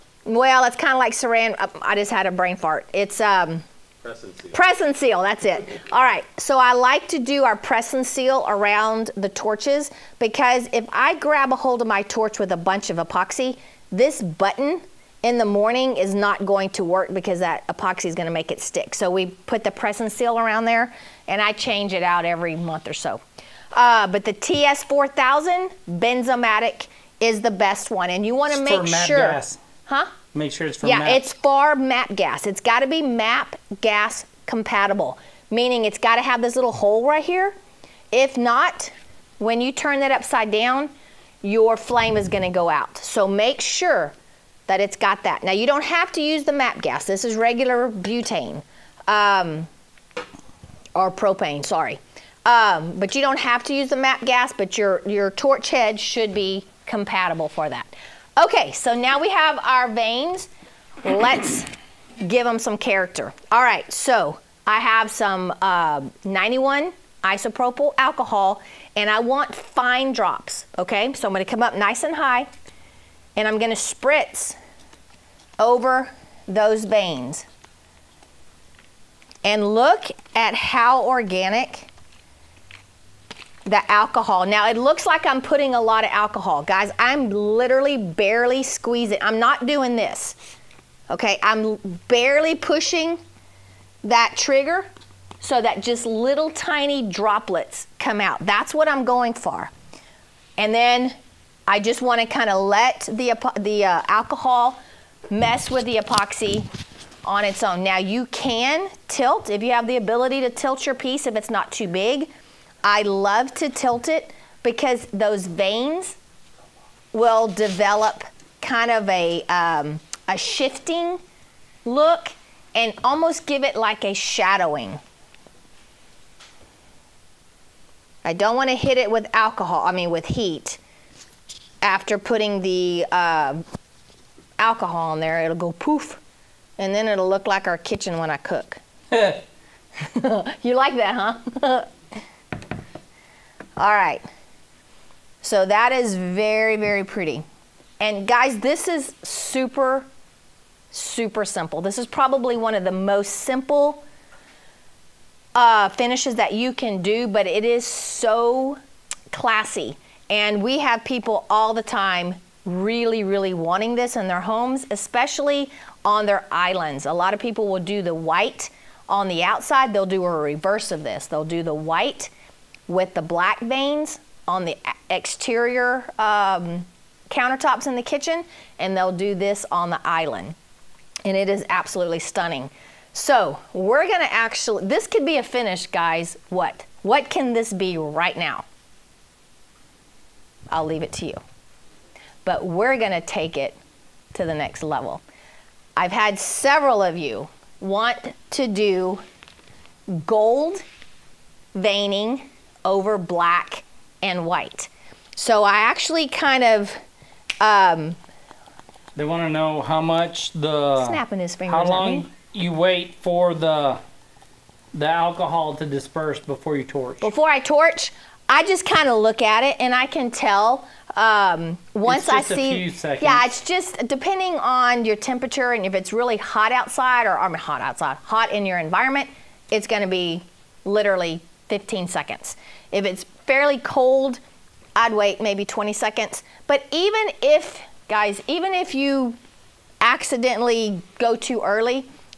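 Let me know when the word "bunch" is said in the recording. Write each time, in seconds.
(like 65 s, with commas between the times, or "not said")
12 s.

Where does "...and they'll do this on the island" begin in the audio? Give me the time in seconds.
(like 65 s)
178 s.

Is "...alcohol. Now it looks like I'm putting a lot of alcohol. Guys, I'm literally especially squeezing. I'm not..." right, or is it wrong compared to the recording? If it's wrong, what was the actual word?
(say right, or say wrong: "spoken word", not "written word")
wrong: "barely", not "especially".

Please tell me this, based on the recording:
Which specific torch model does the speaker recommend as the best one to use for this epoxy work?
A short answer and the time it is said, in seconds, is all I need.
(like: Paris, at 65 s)
TS4000 Benzomatic, at 24 s.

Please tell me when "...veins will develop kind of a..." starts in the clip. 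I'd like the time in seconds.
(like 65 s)
115 s.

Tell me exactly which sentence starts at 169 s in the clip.
They'll do a reverse of this.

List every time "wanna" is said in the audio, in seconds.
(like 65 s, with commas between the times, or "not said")
28 s, 102 s.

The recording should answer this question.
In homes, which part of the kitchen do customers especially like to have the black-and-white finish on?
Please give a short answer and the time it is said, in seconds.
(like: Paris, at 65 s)
islands, at 166 s.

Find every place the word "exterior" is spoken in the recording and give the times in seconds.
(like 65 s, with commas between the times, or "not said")
175 s.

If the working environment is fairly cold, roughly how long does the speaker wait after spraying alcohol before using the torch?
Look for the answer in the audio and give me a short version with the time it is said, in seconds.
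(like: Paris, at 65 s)
20 seconds, at 235 s.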